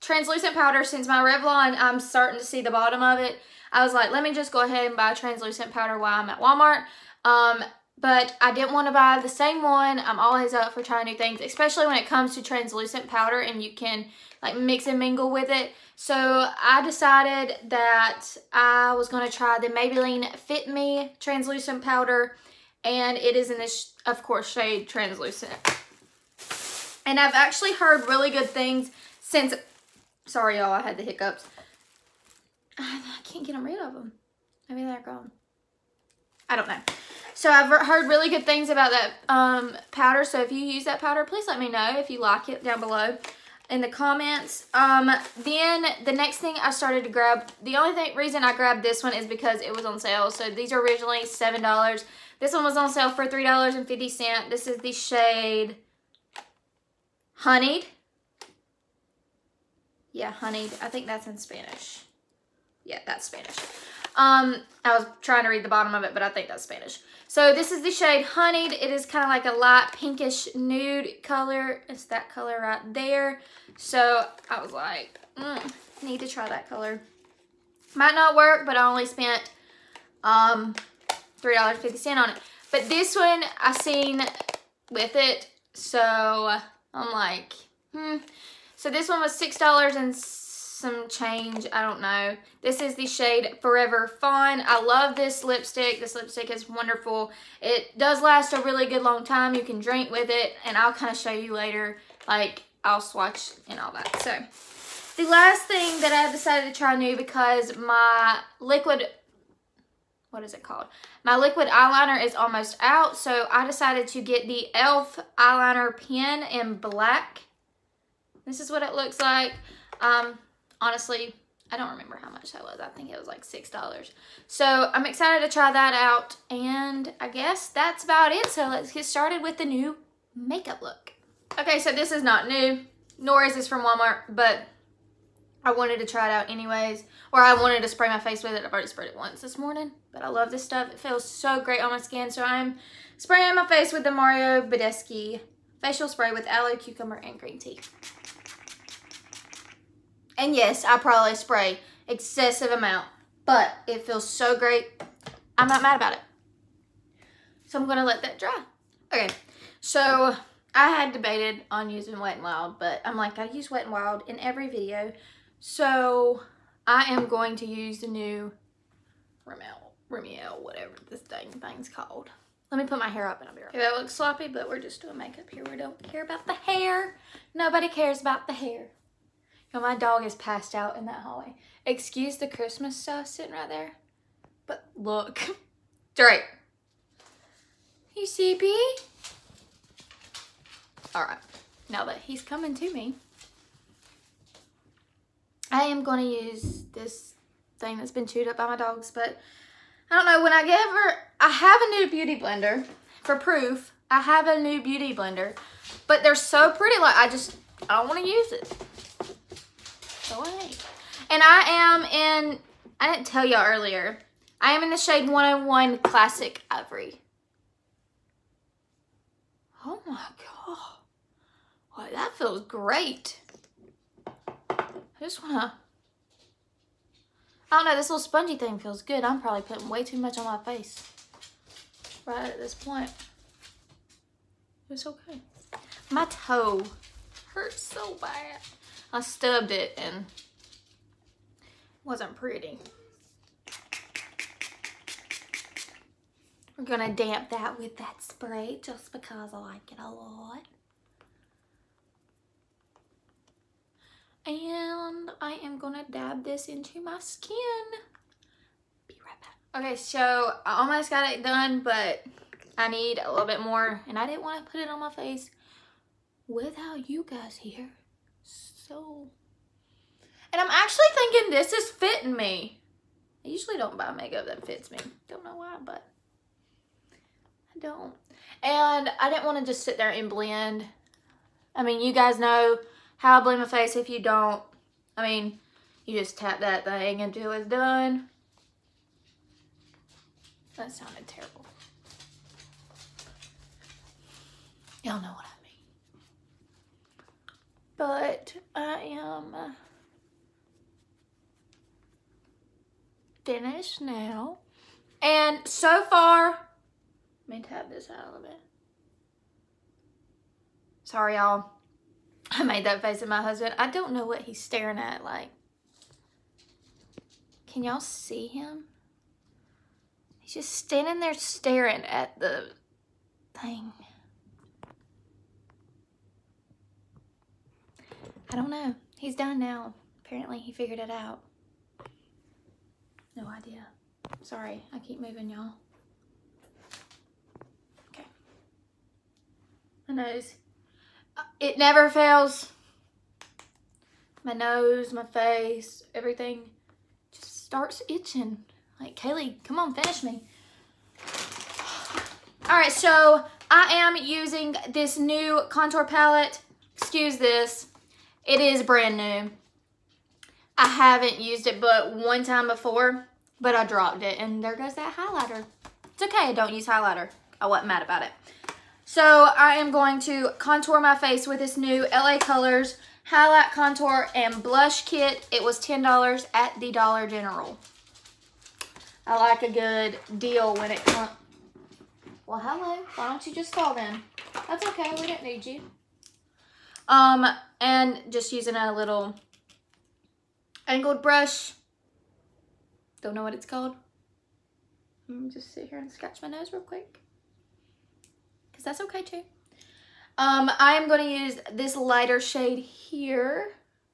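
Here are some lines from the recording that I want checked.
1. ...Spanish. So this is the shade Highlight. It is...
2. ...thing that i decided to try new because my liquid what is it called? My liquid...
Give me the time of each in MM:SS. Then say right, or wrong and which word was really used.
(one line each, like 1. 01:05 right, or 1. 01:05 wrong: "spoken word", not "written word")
1. 01:06 wrong: "Honeyed", not "Highlight"
2. 01:45 right.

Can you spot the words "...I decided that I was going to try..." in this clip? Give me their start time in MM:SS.
00:16.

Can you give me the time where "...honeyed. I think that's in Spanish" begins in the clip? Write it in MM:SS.
01:00.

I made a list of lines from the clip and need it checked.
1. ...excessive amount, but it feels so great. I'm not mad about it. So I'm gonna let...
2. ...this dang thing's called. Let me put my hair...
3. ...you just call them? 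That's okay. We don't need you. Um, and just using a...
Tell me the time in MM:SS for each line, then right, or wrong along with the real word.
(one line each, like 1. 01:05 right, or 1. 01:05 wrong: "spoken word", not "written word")
1. 02:32 right
2. 02:51 right
3. 06:23 right.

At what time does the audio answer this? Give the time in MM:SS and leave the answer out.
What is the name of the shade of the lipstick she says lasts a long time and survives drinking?
01:33.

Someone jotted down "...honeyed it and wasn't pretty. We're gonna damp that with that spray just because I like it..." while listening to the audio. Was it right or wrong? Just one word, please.
wrong.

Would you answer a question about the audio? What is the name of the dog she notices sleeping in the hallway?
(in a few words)
Drake.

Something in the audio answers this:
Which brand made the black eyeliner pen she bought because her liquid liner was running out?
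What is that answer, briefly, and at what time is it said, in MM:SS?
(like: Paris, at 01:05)
e.l.f., at 01:54.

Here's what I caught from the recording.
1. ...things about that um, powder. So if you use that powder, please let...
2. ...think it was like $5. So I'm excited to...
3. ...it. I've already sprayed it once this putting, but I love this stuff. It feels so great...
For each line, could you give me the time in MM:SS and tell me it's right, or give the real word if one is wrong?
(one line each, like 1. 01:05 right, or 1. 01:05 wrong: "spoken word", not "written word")
1. 00:38 right
2. 02:02 wrong: "6", not "5"
3. 02:18 wrong: "morning", not "putting".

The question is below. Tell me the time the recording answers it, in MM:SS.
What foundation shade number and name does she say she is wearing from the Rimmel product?
03:35.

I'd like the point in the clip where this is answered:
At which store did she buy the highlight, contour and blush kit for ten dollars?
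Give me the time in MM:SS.
06:16.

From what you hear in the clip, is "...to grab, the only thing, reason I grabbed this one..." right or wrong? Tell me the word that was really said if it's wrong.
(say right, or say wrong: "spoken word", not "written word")
right.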